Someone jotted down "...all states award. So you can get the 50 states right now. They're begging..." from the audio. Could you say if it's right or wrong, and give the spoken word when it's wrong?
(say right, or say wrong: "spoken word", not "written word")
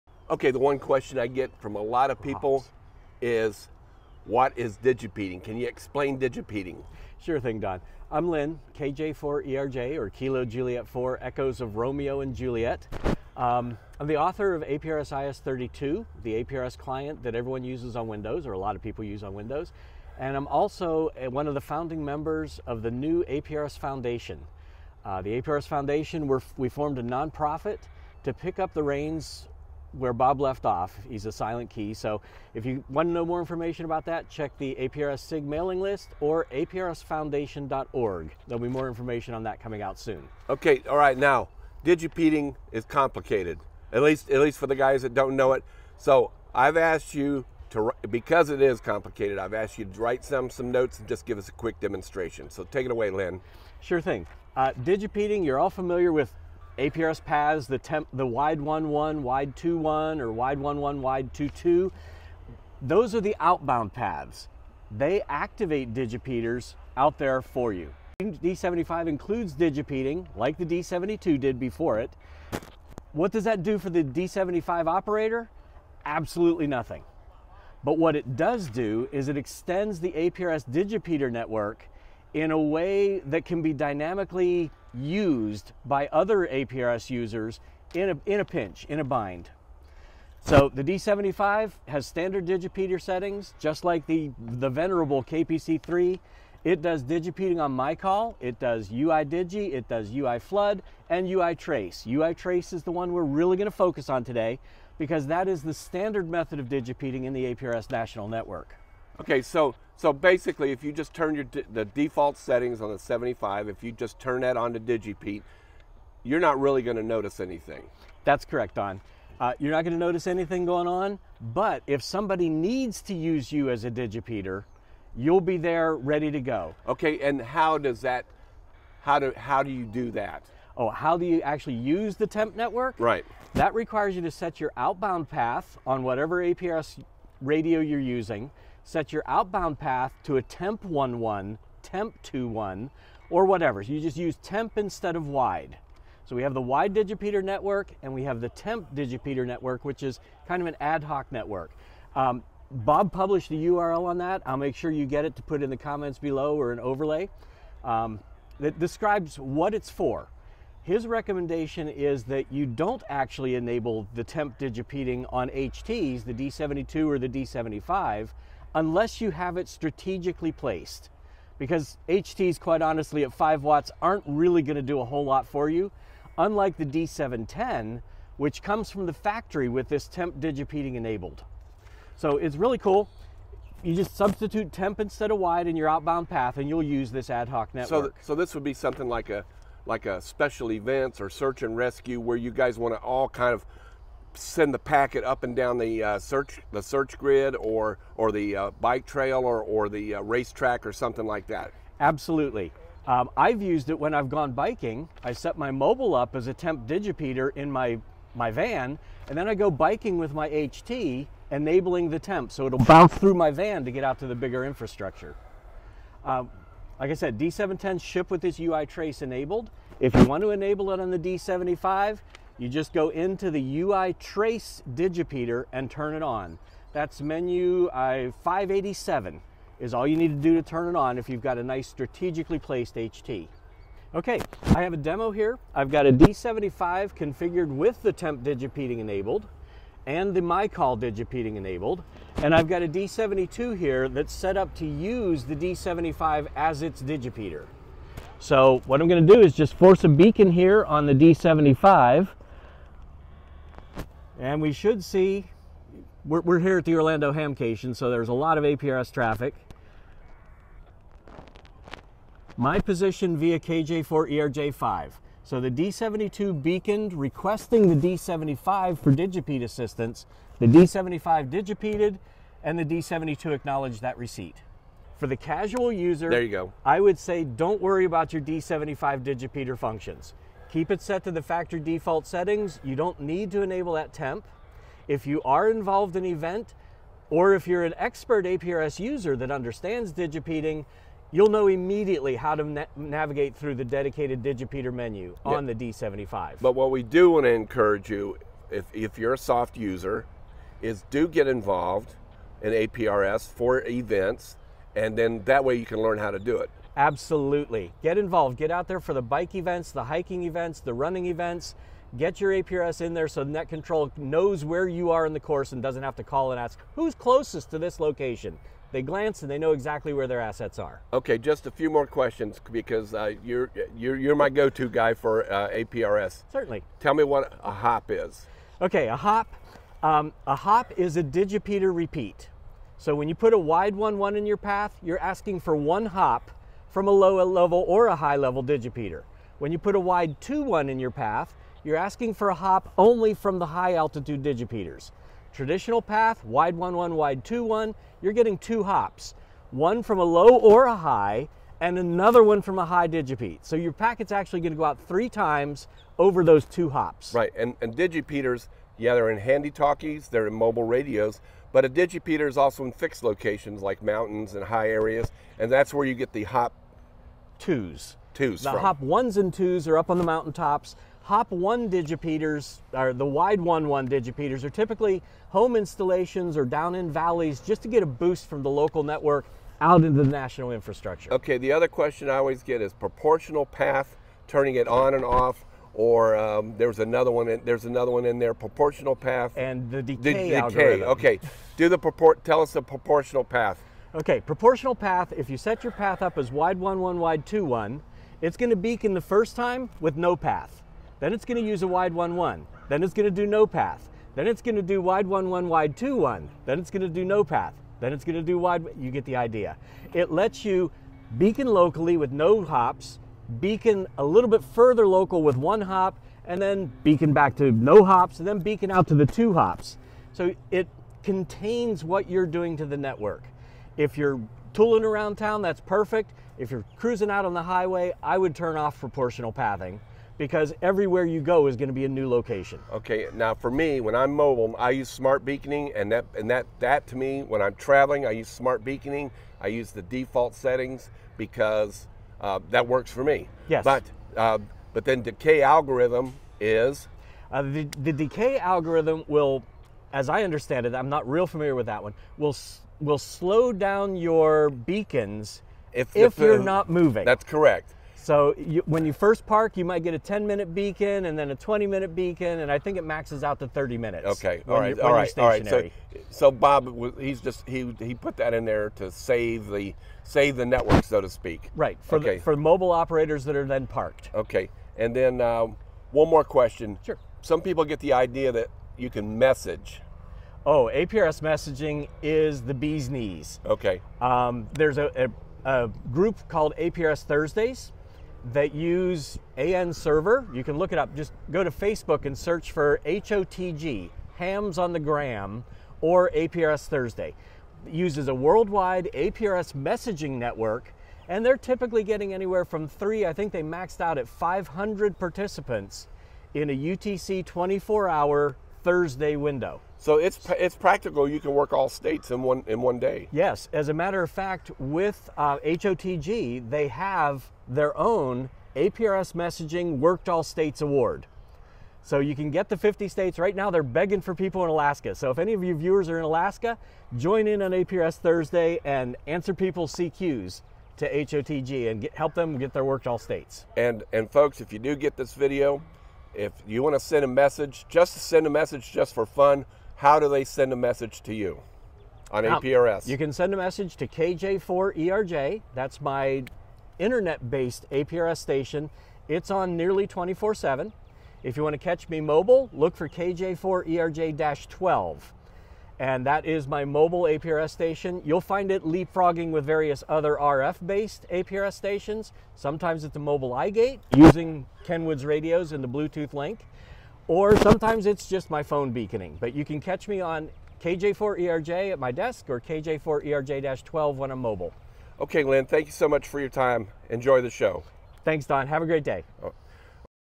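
right.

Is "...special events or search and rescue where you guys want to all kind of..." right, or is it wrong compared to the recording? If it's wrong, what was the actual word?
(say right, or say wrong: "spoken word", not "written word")
right.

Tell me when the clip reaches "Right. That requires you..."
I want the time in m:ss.
2:12.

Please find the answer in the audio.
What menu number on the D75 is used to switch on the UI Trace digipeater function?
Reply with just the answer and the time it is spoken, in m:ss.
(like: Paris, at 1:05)
587, at 3:48.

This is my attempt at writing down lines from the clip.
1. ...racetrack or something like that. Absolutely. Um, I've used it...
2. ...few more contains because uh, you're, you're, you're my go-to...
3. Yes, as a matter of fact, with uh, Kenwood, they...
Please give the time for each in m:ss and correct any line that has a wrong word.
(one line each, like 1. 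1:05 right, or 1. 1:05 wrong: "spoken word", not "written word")
1. 3:20 right
2. 5:21 wrong: "questions", not "contains"
3. 8:33 wrong: "HOTG", not "Kenwood".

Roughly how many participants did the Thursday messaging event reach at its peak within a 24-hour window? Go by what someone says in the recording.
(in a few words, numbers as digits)
500.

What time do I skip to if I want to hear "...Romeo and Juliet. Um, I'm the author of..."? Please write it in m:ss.
0:11.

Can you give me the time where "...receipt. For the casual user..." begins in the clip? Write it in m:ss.
4:34.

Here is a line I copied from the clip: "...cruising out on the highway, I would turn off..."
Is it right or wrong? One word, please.
right.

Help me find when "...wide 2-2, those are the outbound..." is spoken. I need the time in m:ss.
1:00.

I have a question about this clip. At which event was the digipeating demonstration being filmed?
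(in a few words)
Orlando Hamcation.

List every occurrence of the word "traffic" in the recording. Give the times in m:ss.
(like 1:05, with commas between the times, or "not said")
4:19.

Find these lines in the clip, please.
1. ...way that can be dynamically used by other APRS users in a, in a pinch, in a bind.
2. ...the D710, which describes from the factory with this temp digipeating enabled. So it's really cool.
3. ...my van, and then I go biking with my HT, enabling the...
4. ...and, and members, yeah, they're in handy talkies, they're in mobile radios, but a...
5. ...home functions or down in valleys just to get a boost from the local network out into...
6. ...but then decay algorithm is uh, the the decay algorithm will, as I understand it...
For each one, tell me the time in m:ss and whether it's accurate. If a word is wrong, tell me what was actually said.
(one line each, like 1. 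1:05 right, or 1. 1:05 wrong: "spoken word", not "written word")
1. 1:22 right
2. 2:56 wrong: "comes", not "describes"
3. 3:28 right
4. 5:57 wrong: "digipeaters", not "members"
5. 6:15 wrong: "installations", not "functions"
6. 7:24 right.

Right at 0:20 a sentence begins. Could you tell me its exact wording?
And I'm also uh, one of the founding members of the new APRS Foundation.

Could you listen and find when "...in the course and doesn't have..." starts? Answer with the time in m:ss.
5:15.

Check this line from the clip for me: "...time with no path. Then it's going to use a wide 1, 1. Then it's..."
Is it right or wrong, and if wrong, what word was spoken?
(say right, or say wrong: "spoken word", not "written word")
right.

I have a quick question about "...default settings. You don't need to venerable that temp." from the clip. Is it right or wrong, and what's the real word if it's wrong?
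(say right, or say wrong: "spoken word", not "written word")
wrong: "enable", not "venerable".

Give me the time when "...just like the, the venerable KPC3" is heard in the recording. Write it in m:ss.
1:33.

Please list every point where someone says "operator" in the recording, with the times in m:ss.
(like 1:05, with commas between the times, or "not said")
1:14, 7:52.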